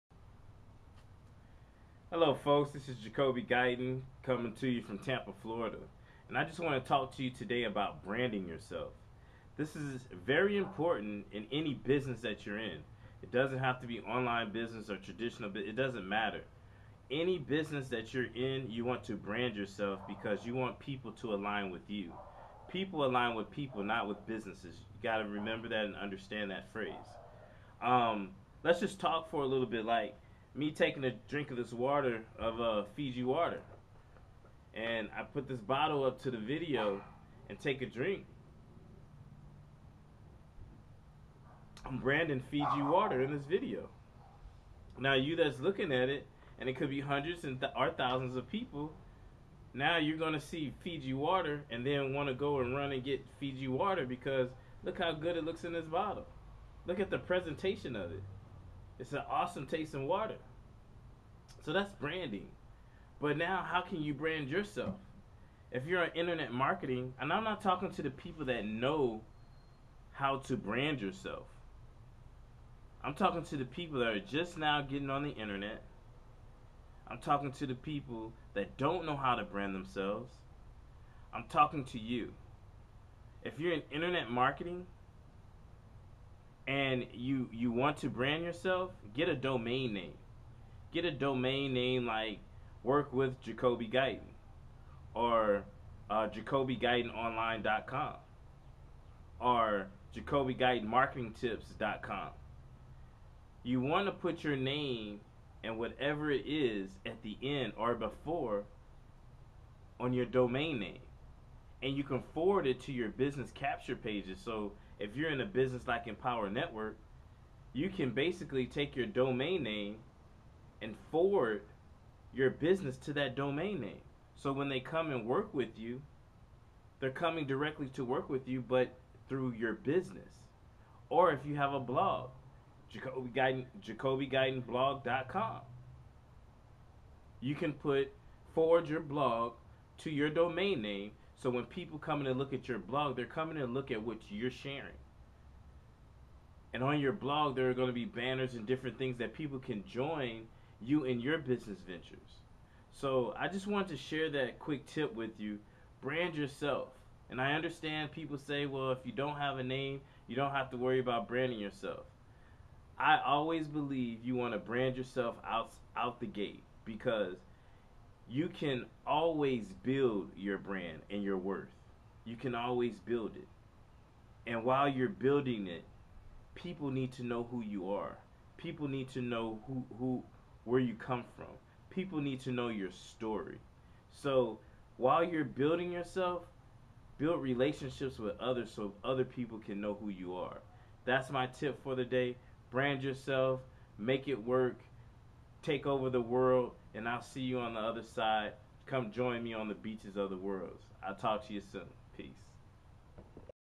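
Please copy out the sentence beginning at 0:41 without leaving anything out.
I'm branding Fiji water in this video.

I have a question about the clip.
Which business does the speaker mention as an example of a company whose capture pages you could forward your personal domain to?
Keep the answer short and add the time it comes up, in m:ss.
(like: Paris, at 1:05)
Empower Network, at 1:56.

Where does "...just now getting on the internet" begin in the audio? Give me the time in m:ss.
1:14.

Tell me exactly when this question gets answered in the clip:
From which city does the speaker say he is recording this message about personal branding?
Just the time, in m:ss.
0:04.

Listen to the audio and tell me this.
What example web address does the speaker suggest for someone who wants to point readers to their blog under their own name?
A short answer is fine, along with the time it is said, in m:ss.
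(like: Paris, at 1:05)
JacobiGuytonBlog.com, at 2:12.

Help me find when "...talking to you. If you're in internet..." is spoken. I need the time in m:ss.
1:21.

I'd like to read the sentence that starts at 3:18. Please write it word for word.
Come join me on the beaches of the world.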